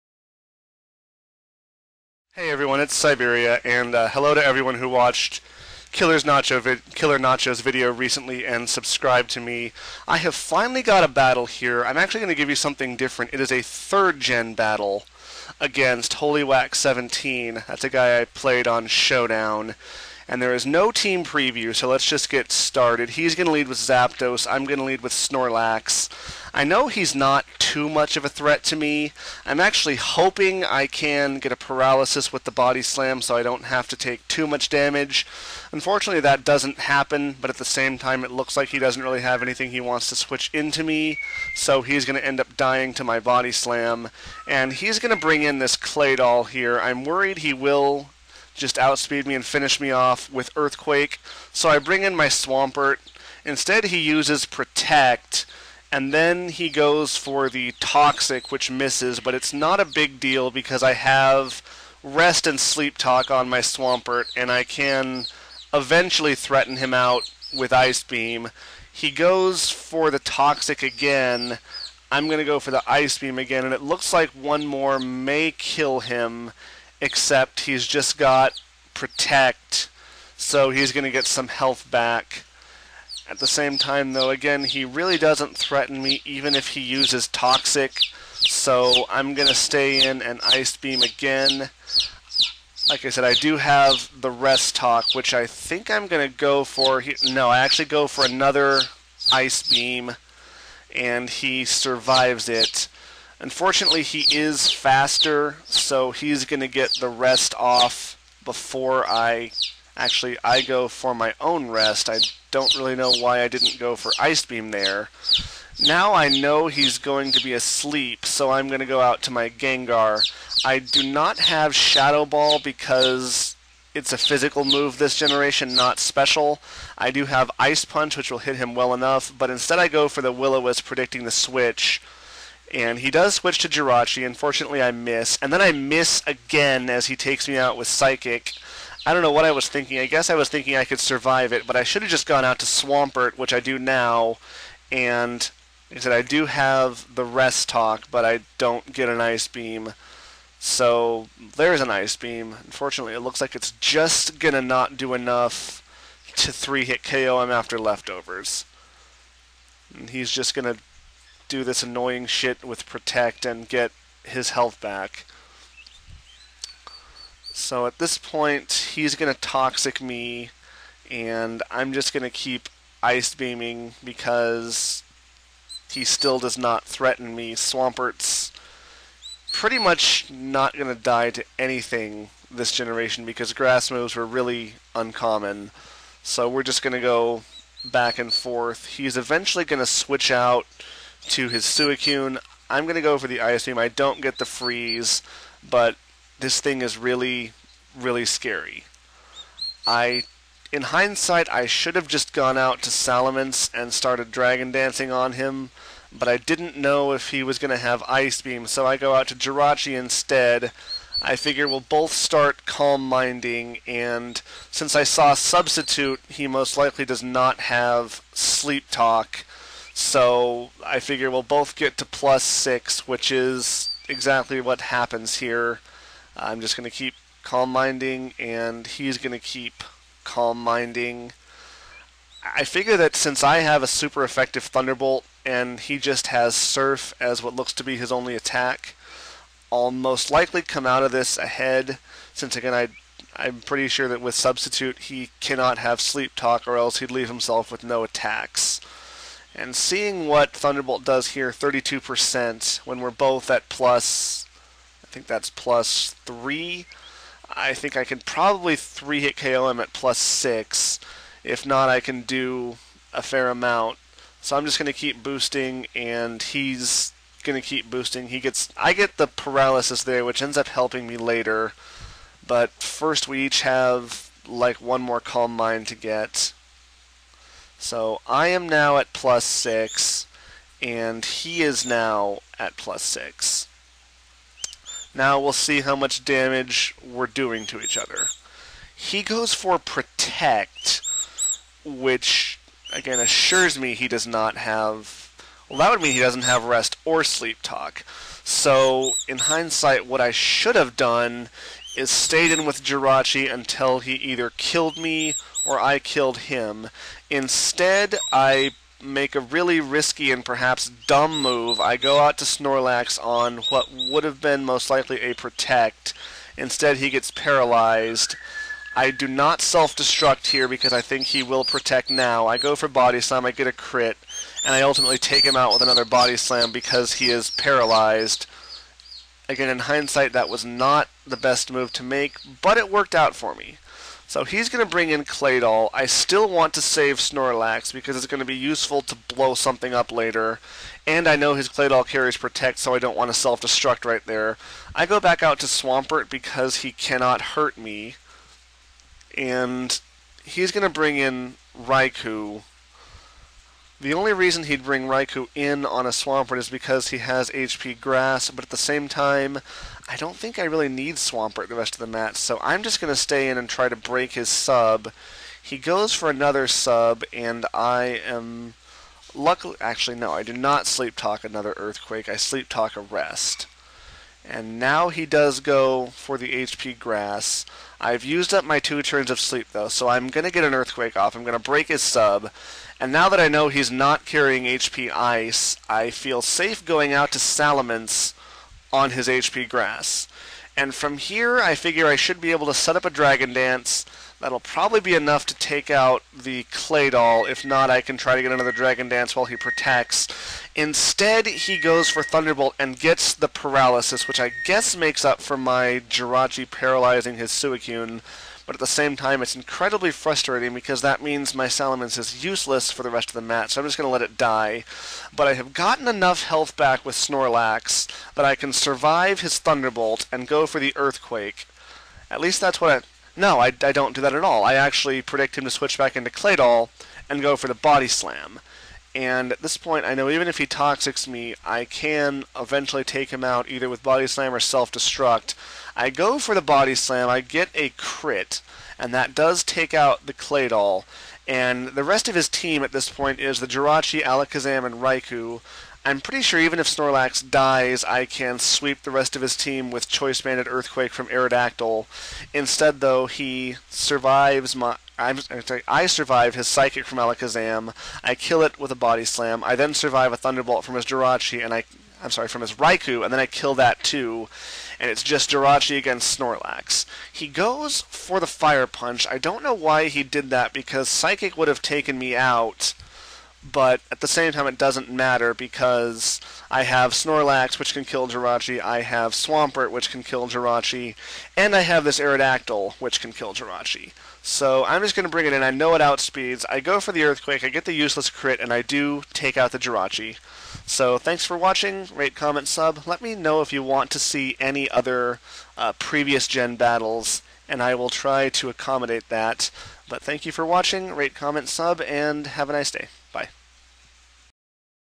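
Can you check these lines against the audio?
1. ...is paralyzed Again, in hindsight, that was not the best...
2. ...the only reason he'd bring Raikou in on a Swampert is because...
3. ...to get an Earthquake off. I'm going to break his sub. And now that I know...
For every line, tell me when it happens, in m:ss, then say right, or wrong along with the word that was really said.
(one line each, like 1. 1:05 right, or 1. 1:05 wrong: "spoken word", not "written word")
1. 5:27 right
2. 5:54 right
3. 6:20 right.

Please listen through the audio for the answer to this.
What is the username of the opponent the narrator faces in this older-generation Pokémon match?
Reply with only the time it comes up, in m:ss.
0:16.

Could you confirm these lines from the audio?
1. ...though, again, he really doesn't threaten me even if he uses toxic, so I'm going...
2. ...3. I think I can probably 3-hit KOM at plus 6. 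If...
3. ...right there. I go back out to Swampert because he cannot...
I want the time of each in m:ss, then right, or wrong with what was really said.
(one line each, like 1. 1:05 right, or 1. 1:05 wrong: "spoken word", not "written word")
1. 1:24 right
2. 4:16 right
3. 5:44 right.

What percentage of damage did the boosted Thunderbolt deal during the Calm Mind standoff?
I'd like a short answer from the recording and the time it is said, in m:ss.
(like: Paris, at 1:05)
32%, at 4:11.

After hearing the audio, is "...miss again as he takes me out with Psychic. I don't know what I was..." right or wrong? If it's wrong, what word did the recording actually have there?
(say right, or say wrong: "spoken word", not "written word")
right.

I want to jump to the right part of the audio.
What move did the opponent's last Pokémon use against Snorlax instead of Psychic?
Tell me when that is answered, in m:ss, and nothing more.
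7:48.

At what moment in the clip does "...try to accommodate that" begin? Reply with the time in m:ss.
8:18.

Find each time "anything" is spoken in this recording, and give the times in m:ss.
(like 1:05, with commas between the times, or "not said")
0:39, 3:01.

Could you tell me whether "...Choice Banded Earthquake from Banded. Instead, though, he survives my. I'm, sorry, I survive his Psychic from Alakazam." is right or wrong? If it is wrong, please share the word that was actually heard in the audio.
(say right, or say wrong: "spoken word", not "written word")
wrong: "Aerodactyl", not "Banded".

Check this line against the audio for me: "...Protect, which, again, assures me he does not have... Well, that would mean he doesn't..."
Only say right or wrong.
right.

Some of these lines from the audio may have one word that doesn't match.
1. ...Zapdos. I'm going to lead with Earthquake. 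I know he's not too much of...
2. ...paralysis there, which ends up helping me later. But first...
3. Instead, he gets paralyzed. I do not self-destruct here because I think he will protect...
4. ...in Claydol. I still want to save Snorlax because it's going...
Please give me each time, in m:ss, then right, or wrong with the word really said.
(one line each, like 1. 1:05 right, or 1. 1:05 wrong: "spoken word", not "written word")
1. 0:23 wrong: "Snorlax", not "Earthquake"
2. 4:29 right
3. 5:16 right
4. 5:35 right.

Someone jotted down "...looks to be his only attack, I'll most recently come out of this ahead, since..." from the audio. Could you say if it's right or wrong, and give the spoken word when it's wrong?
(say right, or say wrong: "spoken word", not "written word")
wrong: "likely", not "recently".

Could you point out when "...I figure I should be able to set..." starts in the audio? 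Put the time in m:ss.
6:31.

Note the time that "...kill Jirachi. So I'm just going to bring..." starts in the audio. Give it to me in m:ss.
8:03.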